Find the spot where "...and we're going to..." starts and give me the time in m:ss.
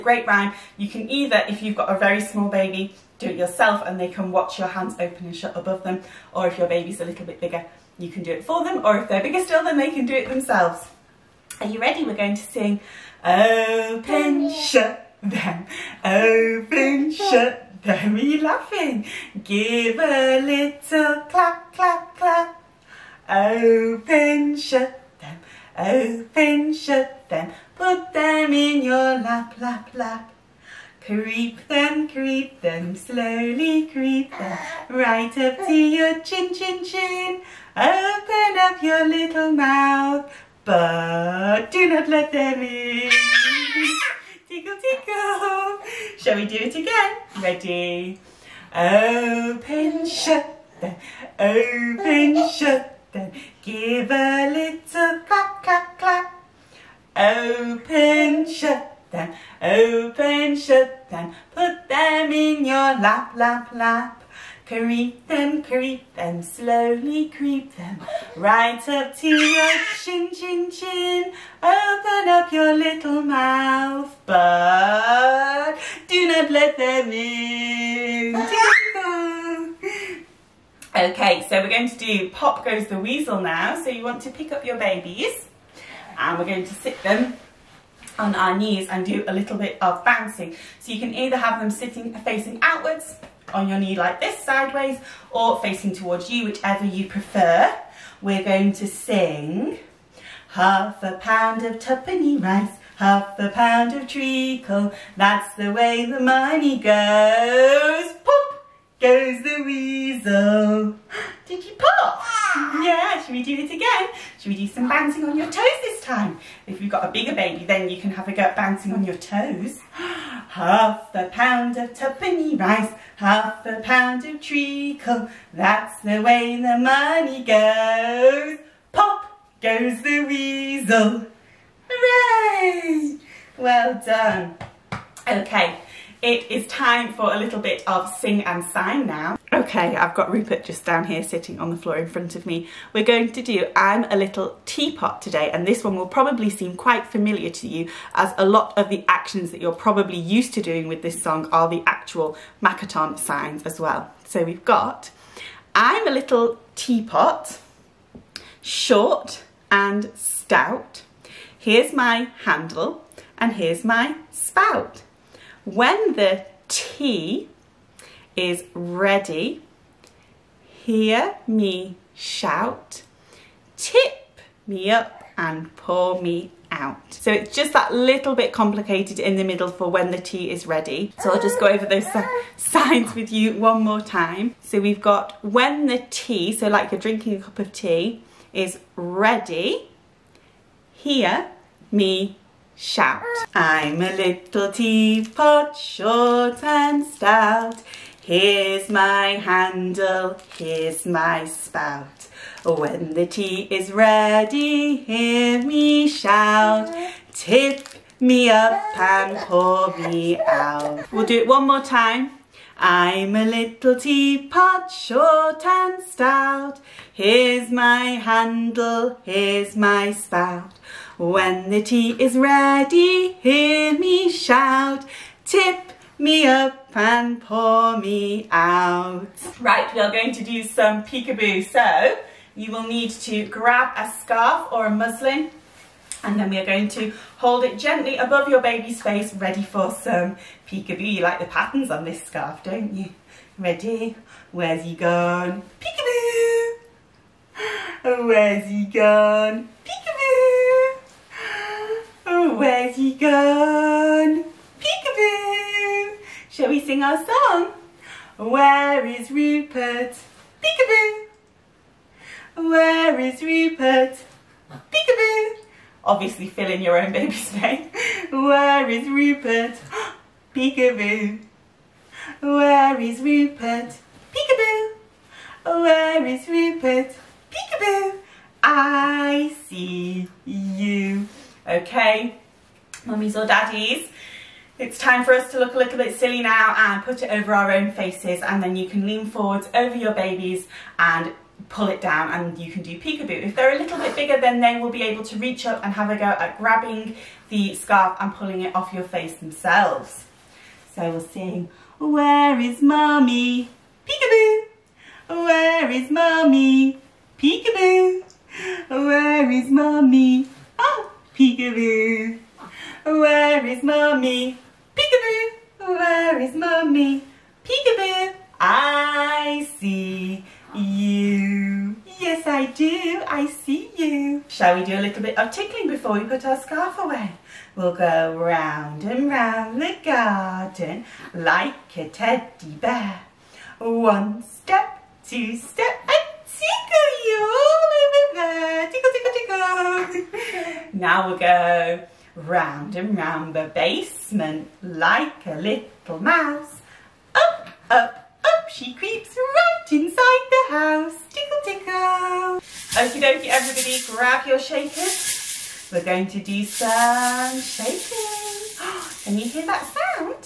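1:26.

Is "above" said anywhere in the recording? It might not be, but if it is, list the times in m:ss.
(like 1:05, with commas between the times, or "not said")
0:05, 3:58.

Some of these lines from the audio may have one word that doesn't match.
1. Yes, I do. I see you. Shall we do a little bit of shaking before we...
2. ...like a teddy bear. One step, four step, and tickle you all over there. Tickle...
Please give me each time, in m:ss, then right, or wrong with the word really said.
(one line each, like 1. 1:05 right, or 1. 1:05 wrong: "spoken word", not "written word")
1. 5:22 wrong: "tickling", not "shaking"
2. 5:31 wrong: "two", not "four".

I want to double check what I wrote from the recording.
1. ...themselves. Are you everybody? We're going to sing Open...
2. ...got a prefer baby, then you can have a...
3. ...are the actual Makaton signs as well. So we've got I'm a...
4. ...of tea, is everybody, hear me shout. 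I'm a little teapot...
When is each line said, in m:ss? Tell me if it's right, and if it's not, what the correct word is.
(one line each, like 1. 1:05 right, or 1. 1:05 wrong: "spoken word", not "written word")
1. 0:10 wrong: "ready", not "everybody"
2. 1:56 wrong: "bigger", not "prefer"
3. 2:31 right
4. 3:07 wrong: "ready", not "everybody".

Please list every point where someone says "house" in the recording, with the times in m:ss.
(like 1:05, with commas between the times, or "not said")
5:50.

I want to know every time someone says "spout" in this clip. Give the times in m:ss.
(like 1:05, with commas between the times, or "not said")
2:44, 3:21, 3:40.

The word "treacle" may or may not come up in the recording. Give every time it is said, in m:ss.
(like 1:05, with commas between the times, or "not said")
1:44, 2:04.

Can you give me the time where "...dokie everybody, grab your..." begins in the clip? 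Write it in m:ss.
5:53.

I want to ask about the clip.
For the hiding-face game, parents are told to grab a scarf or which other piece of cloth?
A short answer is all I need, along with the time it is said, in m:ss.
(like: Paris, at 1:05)
A muslin, at 3:54.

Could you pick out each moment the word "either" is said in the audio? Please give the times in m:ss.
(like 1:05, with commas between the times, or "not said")
0:01, 1:31.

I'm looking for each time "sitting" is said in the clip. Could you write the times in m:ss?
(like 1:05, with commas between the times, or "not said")
1:31, 2:21.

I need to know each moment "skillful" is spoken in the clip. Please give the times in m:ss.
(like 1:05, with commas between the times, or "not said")
not said.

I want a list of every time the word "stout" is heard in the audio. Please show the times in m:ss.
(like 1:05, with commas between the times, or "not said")
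2:40, 3:17, 3:36.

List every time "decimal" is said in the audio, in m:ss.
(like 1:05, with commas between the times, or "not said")
not said.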